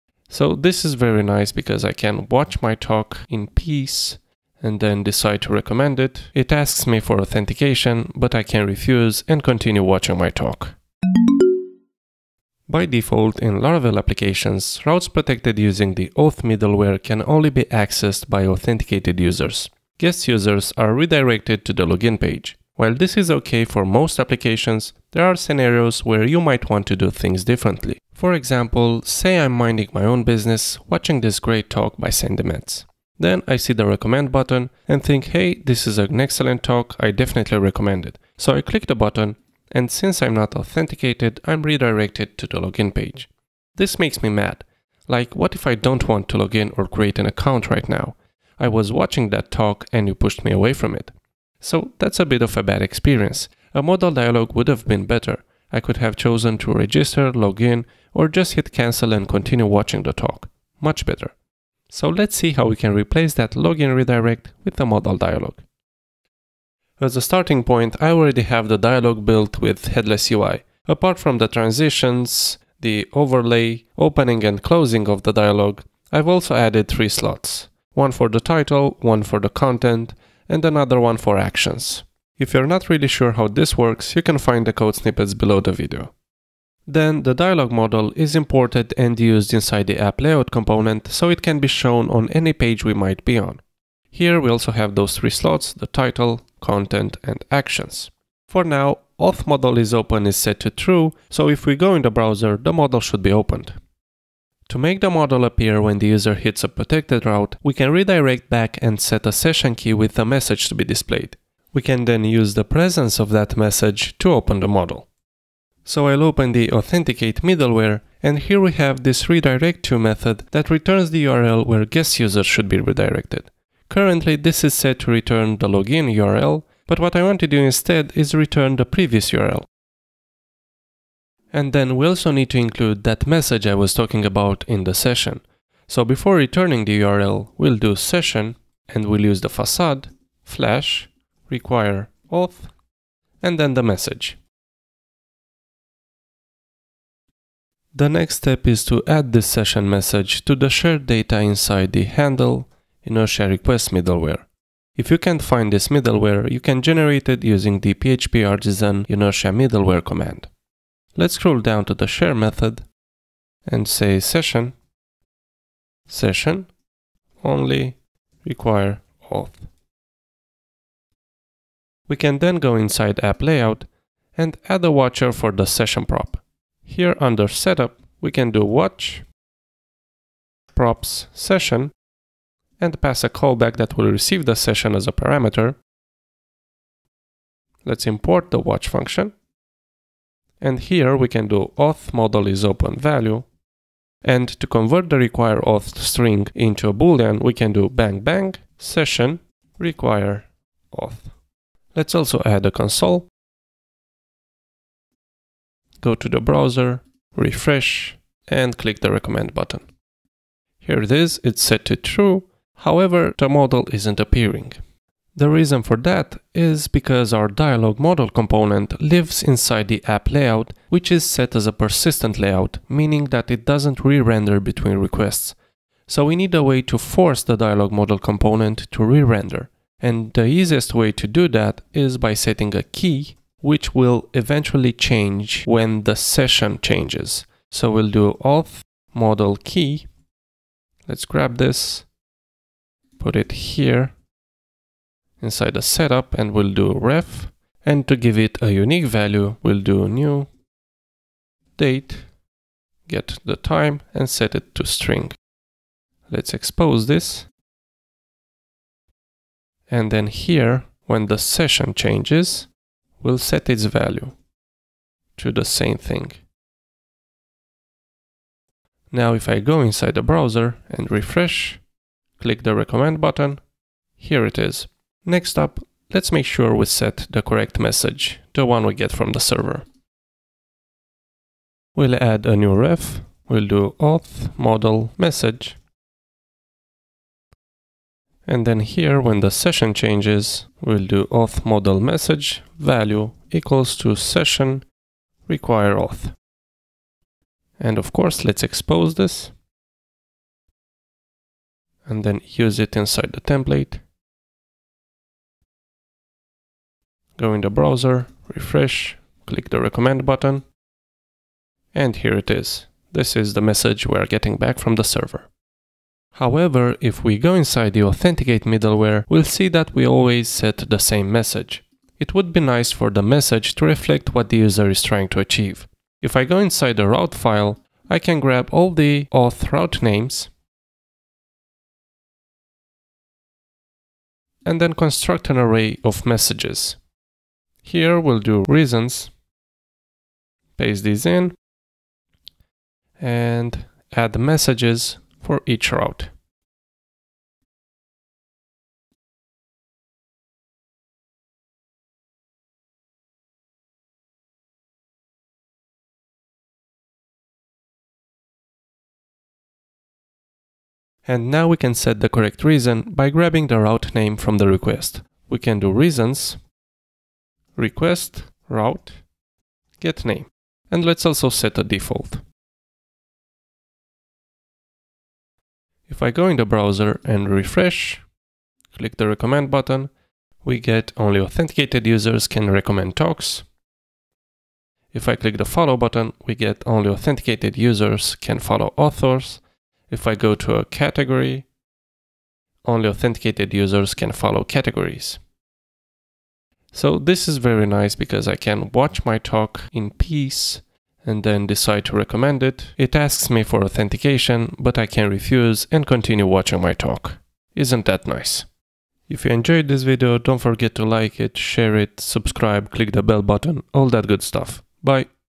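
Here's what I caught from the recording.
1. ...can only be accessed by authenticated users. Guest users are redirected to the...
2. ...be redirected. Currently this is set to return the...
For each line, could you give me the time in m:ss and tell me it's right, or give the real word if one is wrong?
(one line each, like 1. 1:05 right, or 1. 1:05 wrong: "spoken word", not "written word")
1. 0:17 right
2. 2:02 right.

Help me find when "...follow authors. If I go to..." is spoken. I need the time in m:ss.
6:28.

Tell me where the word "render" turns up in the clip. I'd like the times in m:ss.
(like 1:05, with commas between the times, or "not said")
3:44, 3:49.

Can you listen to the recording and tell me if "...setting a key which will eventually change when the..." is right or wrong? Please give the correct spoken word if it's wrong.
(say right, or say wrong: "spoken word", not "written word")
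right.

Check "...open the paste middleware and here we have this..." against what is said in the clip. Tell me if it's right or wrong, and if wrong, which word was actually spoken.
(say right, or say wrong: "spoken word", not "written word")
wrong: "authenticate", not "paste".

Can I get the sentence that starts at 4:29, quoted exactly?
Now if I go inside the browser and refresh, click the recommend button, here it is.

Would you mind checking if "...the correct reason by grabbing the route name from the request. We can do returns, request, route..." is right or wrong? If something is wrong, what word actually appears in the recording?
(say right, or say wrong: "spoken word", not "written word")
wrong: "reasons", not "returns".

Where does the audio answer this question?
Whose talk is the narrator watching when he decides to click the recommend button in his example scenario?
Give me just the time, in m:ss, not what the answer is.
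0:32.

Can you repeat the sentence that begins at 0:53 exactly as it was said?
A modal dialog would have been better.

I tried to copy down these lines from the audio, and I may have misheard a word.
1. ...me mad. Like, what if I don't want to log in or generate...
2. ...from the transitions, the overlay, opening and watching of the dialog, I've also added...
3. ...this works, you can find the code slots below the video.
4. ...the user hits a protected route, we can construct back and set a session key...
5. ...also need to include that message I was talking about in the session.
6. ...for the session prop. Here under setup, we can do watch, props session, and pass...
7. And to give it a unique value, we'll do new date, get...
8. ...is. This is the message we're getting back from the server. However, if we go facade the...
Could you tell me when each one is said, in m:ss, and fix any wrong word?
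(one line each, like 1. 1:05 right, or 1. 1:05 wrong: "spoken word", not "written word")
1. 0:44 wrong: "create", not "generate"
2. 1:11 wrong: "closing", not "watching"
3. 1:23 wrong: "snippets", not "slots"
4. 1:45 wrong: "redirect", not "construct"
5. 2:12 right
6. 2:55 right
7. 4:07 right
8. 5:12 wrong: "inside", not "facade".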